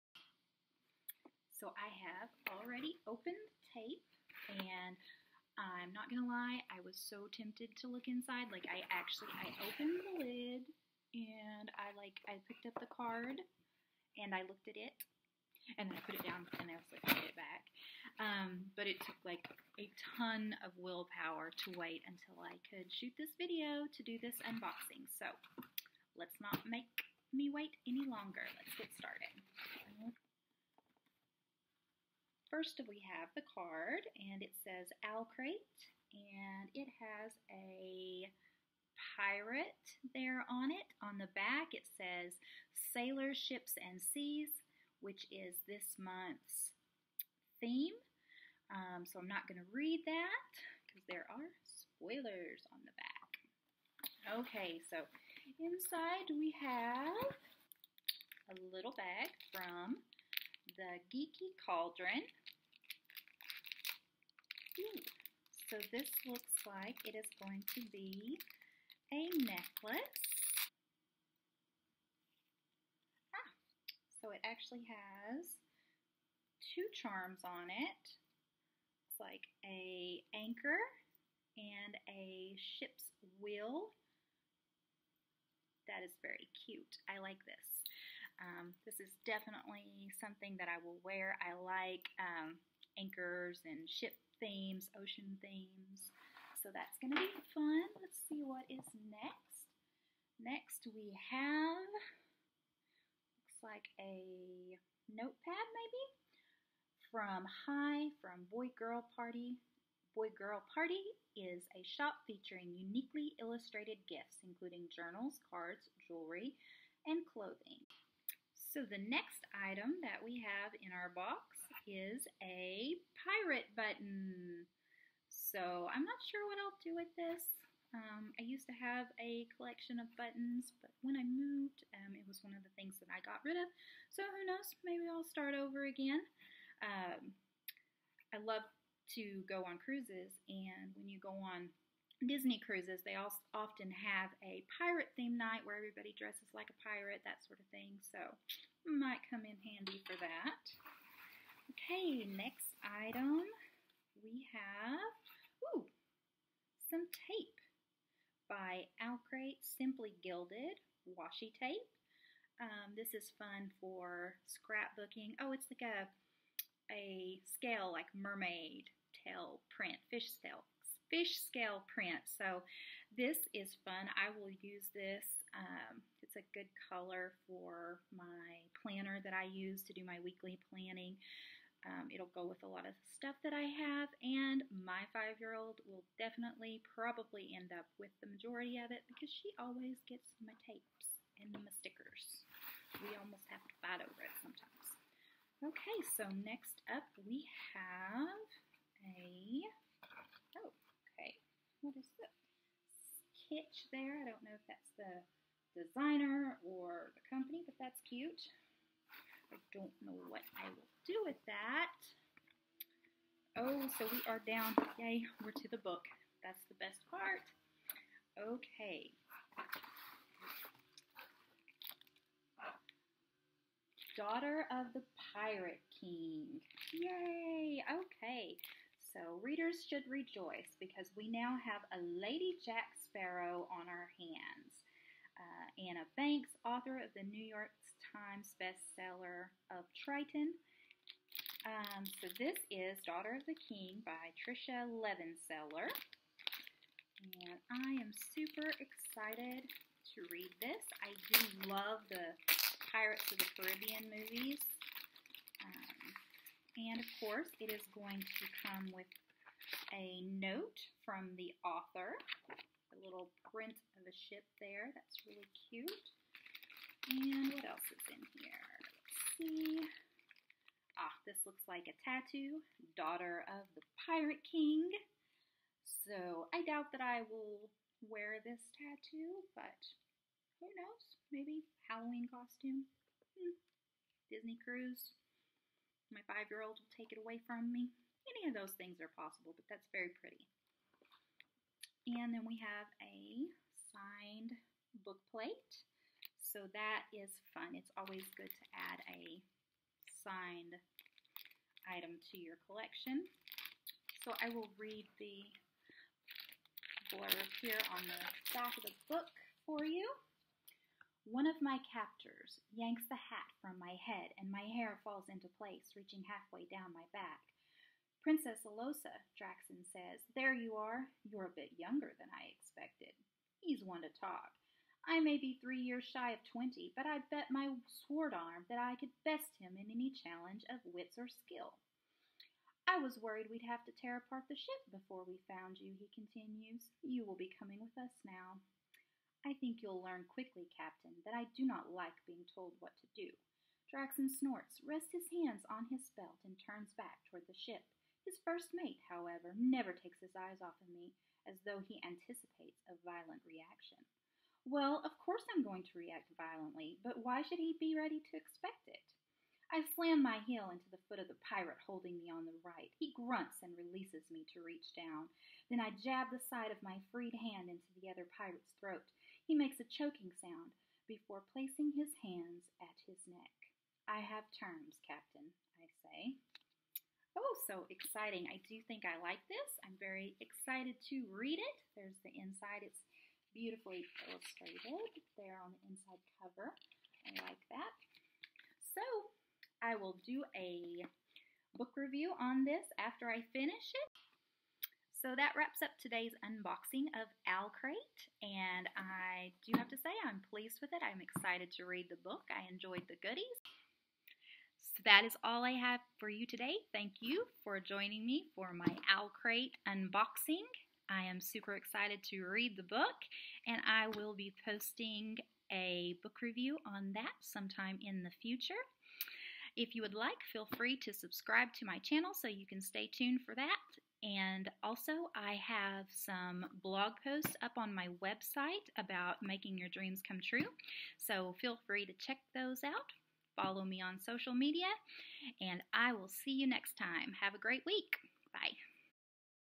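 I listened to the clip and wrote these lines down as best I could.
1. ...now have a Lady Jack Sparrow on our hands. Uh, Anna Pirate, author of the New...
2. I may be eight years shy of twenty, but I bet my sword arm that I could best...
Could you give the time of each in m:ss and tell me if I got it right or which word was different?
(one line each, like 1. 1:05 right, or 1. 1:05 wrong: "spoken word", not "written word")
1. 3:51 wrong: "Banks", not "Pirate"
2. 5:25 wrong: "three", not "eight".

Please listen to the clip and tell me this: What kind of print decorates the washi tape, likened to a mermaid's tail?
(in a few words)
fish scale.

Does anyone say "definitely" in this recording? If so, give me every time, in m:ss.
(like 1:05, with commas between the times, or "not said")
1:29, 3:06.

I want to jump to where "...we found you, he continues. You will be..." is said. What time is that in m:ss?
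5:35.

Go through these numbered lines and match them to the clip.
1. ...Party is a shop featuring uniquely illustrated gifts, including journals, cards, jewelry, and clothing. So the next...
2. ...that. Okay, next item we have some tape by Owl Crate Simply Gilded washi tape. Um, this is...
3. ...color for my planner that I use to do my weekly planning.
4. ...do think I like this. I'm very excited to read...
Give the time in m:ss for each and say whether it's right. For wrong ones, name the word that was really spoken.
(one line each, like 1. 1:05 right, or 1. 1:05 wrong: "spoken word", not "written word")
1. 1:50 right
2. 2:30 right
3. 2:56 right
4. 6:18 right.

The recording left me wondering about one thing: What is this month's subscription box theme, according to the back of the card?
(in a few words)
Sailor Ships and Seas.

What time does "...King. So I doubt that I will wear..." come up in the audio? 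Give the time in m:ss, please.
4:34.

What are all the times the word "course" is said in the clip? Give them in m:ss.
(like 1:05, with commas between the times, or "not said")
4:17, 5:55.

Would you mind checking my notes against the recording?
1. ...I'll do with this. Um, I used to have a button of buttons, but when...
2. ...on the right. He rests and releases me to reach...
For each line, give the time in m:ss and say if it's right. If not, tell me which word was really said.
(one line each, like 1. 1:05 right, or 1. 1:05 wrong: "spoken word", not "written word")
1. 2:06 wrong: "collection", not "button"
2. 6:02 wrong: "grunts", not "rests".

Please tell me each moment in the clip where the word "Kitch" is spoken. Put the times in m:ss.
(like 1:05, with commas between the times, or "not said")
3:23.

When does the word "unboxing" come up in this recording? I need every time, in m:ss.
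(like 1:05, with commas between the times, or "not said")
0:24, 6:36, 6:49.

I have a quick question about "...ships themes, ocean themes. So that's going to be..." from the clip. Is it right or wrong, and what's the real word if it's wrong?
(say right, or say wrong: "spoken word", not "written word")
right.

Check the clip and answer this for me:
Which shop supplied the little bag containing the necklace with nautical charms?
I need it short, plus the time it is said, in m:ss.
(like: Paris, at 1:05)
the Geeky Cauldron, at 1:00.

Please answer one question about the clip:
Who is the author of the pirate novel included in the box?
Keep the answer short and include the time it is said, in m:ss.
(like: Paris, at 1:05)
Tricia Levenseller, at 4:04.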